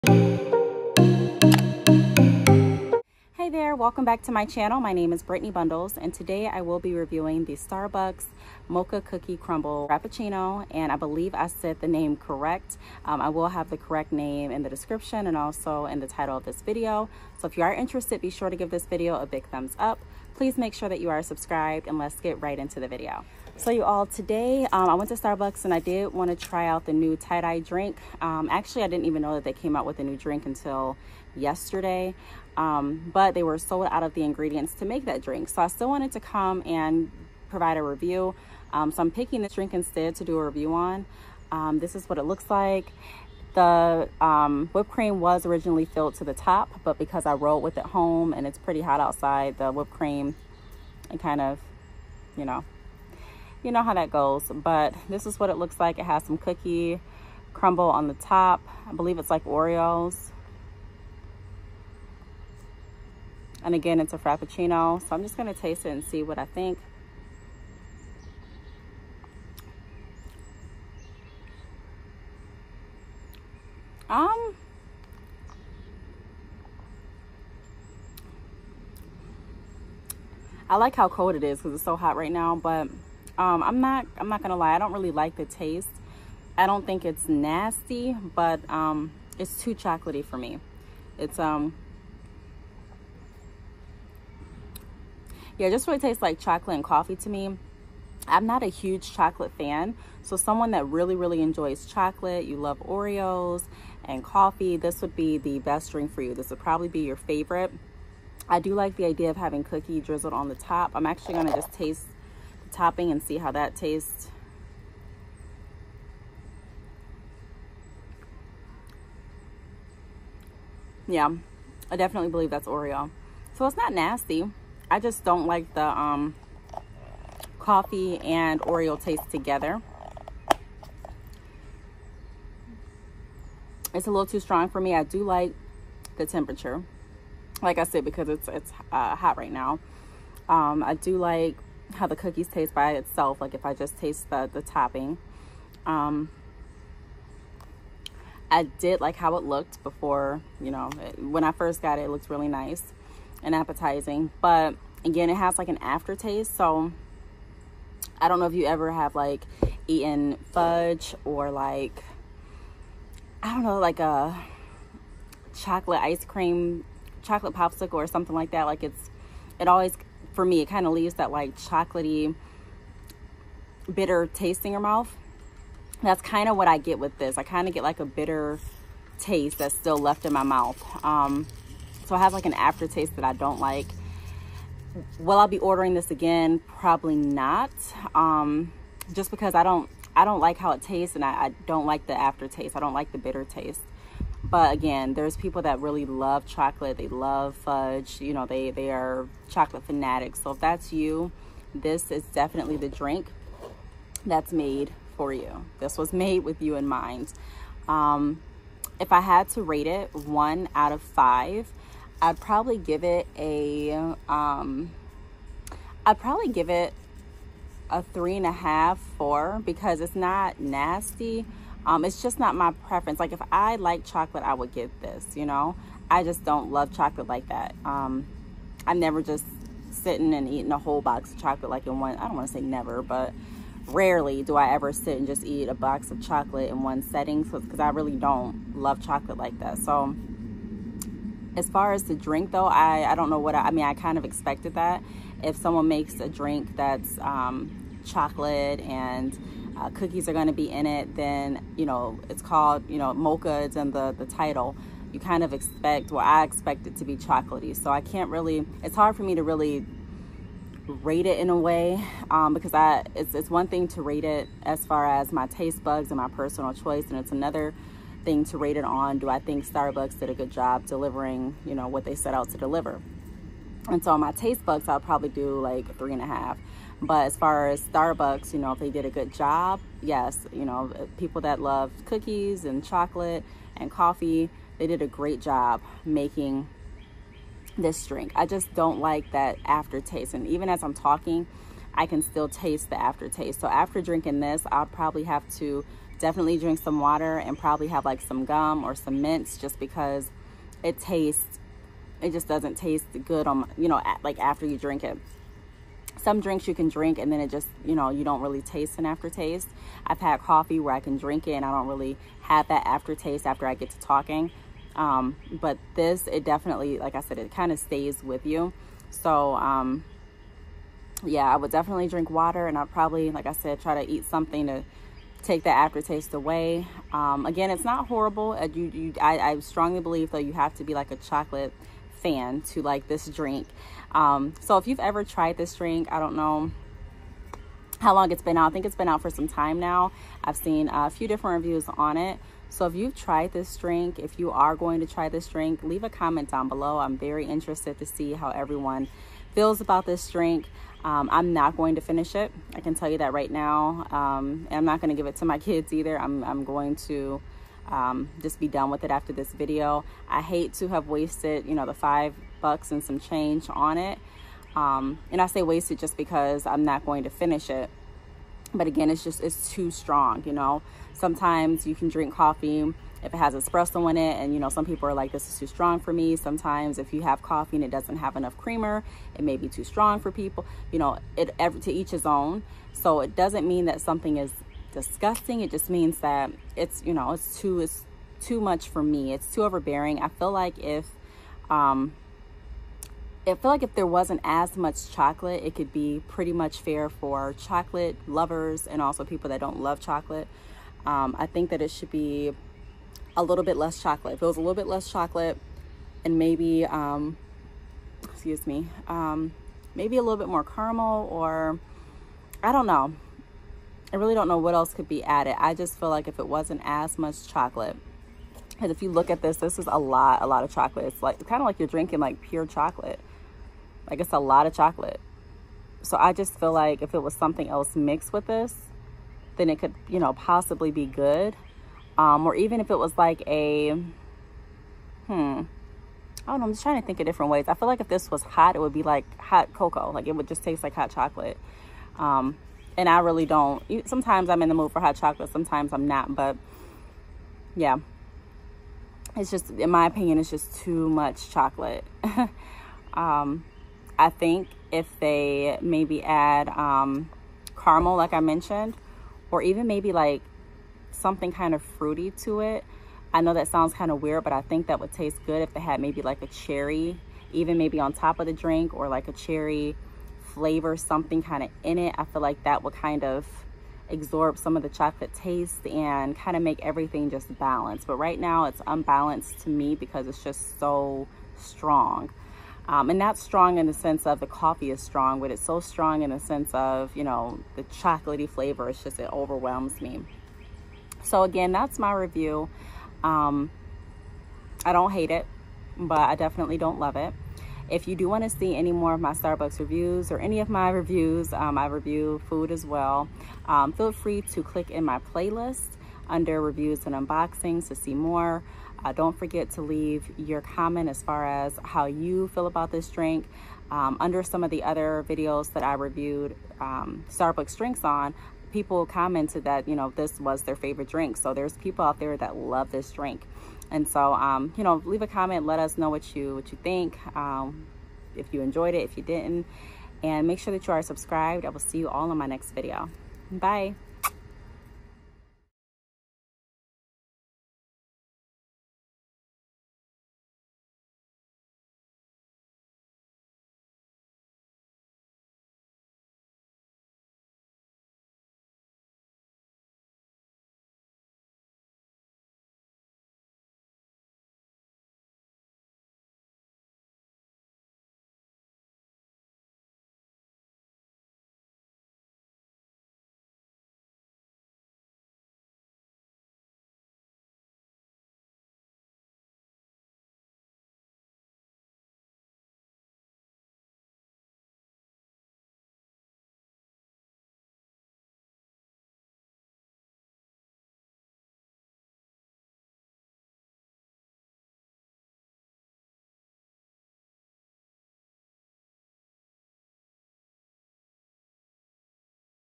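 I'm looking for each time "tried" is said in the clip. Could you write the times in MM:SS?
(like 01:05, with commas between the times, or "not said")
05:35, 05:43.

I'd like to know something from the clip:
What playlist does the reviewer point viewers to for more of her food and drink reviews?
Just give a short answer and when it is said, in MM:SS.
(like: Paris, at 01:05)
reviews and unboxings, at 08:26.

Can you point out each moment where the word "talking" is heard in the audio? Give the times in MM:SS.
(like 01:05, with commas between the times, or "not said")
04:50, 05:13.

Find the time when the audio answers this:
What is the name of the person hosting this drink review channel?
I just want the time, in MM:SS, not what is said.
00:05.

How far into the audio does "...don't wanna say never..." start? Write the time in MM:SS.
03:52.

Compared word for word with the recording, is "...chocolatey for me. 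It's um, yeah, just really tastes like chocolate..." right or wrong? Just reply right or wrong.
right.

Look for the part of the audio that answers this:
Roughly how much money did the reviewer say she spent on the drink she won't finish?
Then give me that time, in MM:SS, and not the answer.
06:01.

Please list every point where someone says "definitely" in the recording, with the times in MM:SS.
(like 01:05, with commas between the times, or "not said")
02:01, 03:22, 04:56, 05:16, 05:21, 08:16.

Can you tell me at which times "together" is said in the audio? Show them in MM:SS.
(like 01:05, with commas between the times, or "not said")
02:09.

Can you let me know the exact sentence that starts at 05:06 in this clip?
Some drinks you can drink and then it just, you know, you don't really taste an aftertaste.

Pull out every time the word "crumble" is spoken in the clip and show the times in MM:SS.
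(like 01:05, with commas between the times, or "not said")
00:09, 00:57.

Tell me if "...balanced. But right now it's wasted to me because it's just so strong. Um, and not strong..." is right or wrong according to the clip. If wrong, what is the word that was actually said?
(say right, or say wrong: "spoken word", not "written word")
wrong: "unbalanced", not "wasted".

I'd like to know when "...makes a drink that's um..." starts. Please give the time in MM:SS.
04:05.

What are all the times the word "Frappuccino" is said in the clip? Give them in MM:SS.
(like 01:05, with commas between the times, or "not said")
00:09, 01:04.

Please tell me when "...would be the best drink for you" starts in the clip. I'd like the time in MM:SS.
01:45.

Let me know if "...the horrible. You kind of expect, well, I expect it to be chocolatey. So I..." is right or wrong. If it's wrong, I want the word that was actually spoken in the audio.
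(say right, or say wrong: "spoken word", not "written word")
wrong: "title", not "horrible".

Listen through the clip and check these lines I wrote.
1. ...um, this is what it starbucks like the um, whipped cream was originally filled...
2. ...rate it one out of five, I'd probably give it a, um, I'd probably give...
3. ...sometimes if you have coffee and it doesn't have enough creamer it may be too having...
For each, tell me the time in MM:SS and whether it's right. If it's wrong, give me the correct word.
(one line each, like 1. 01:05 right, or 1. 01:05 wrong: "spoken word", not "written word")
1. 00:41 wrong: "looks", not "starbucks"
2. 03:29 right
3. 06:16 wrong: "strong", not "having".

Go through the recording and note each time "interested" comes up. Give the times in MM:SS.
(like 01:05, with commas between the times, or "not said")
00:17, 05:47.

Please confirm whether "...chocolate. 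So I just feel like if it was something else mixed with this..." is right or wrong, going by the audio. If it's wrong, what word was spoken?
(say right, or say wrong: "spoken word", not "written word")
right.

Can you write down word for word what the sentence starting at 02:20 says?
Um, I do like how the cookies taste by itself.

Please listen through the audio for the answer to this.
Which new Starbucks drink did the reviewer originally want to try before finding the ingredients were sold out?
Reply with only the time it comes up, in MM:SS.
00:27.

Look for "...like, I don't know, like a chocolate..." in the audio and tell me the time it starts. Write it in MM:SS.
02:41.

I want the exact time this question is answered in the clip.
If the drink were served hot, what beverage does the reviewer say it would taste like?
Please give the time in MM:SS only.
07:19.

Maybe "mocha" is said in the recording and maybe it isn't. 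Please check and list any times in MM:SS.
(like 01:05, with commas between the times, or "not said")
00:08, 04:13.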